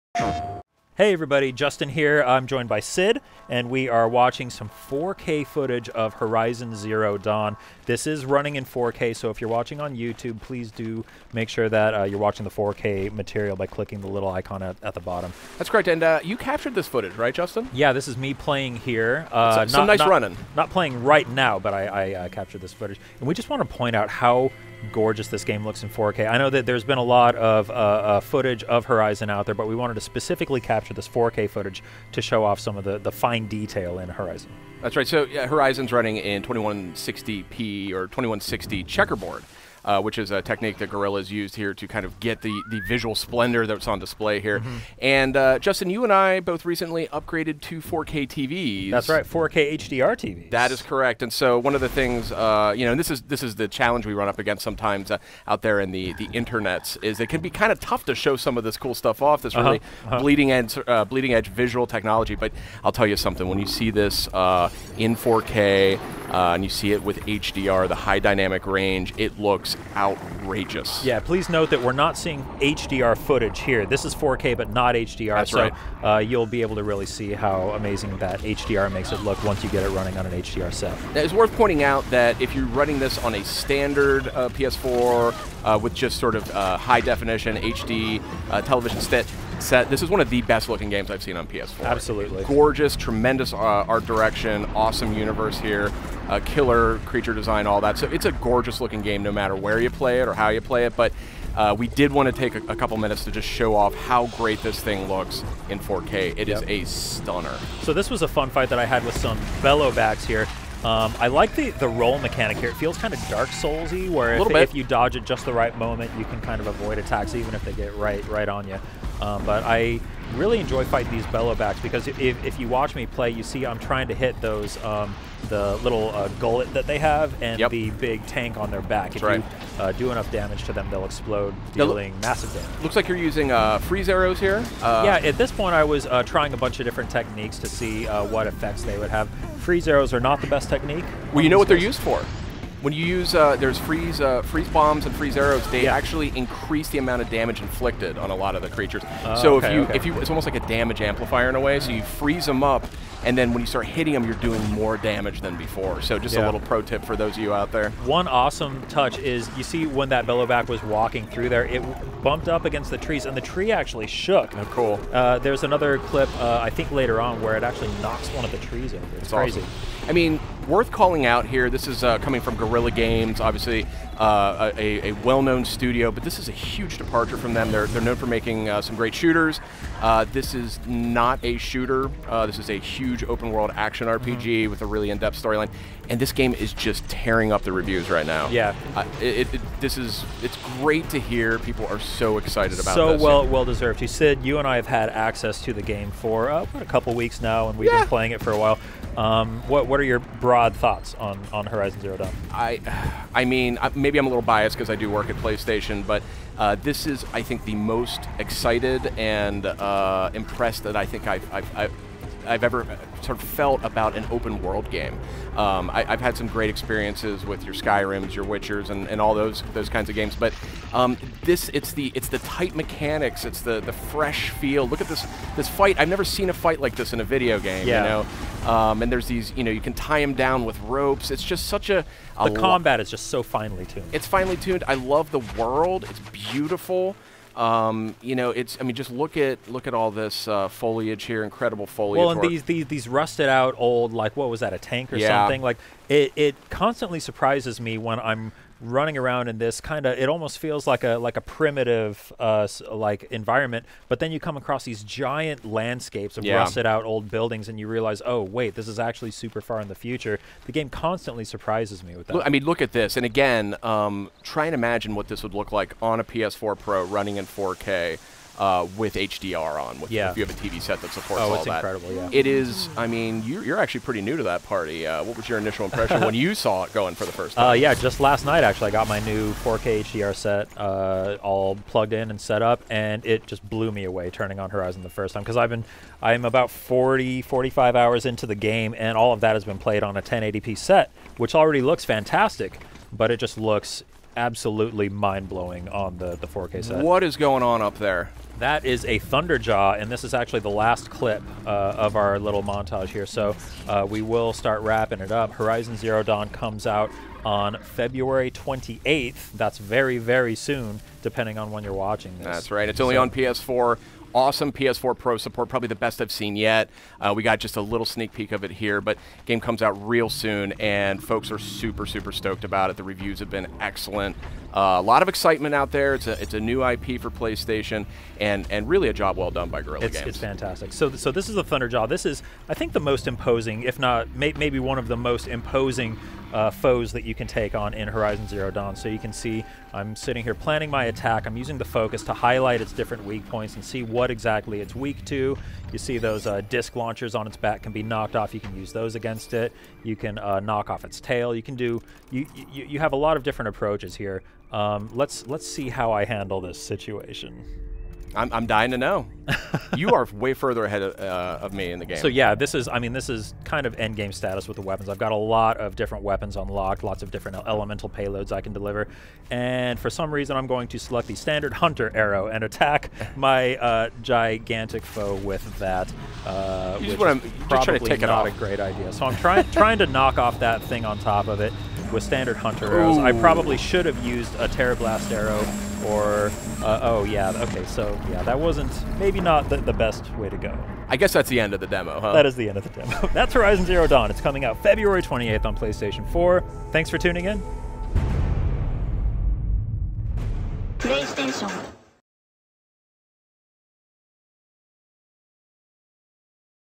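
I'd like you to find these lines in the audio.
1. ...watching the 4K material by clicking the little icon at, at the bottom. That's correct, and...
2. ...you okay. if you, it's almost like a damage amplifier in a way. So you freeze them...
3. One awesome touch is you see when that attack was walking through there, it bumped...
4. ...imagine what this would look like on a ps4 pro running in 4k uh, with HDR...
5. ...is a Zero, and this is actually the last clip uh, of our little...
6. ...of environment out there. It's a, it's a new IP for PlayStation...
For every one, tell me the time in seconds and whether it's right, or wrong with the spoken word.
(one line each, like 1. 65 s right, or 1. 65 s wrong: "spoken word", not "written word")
1. 12 s right
2. 149 s right
3. 158 s wrong: "bellowback", not "attack"
4. 264 s right
5. 298 s wrong: "Thunderjaw", not "Zero"
6. 325 s wrong: "excitement", not "environment".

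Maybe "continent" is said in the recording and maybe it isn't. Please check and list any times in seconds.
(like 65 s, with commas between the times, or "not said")
not said.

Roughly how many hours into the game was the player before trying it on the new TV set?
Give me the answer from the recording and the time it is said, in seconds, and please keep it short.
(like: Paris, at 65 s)
40 to 45 hours, at 286 s.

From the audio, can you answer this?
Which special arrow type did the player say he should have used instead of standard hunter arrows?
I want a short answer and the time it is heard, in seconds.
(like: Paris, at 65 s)
Tearblast arrow, at 384 s.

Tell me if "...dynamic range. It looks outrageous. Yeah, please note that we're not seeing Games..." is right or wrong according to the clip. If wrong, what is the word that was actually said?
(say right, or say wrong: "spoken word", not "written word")
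wrong: "HDR", not "Games".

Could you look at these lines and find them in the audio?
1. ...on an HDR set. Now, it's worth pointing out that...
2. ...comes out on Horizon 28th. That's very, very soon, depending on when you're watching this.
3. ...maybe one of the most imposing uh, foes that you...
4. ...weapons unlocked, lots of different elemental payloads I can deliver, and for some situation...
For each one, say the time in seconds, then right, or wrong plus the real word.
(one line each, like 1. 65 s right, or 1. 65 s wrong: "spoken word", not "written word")
1. 80 s right
2. 306 s wrong: "February", not "Horizon"
3. 334 s right
4. 366 s wrong: "reason", not "situation".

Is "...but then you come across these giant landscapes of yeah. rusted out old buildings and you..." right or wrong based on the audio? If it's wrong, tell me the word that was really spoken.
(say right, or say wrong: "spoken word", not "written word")
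right.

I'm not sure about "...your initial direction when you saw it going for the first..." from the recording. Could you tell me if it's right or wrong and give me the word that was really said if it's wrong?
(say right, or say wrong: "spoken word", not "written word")
wrong: "impression", not "direction".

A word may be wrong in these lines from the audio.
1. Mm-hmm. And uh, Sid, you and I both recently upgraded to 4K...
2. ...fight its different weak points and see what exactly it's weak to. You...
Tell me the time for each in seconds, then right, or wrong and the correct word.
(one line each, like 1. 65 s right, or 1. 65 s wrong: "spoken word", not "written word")
1. 44 s wrong: "Justin", not "Sid"
2. 342 s wrong: "highlight", not "fight".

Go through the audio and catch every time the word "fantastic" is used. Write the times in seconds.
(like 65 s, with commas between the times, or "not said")
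292 s, 330 s.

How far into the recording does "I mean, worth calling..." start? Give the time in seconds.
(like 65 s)
170 s.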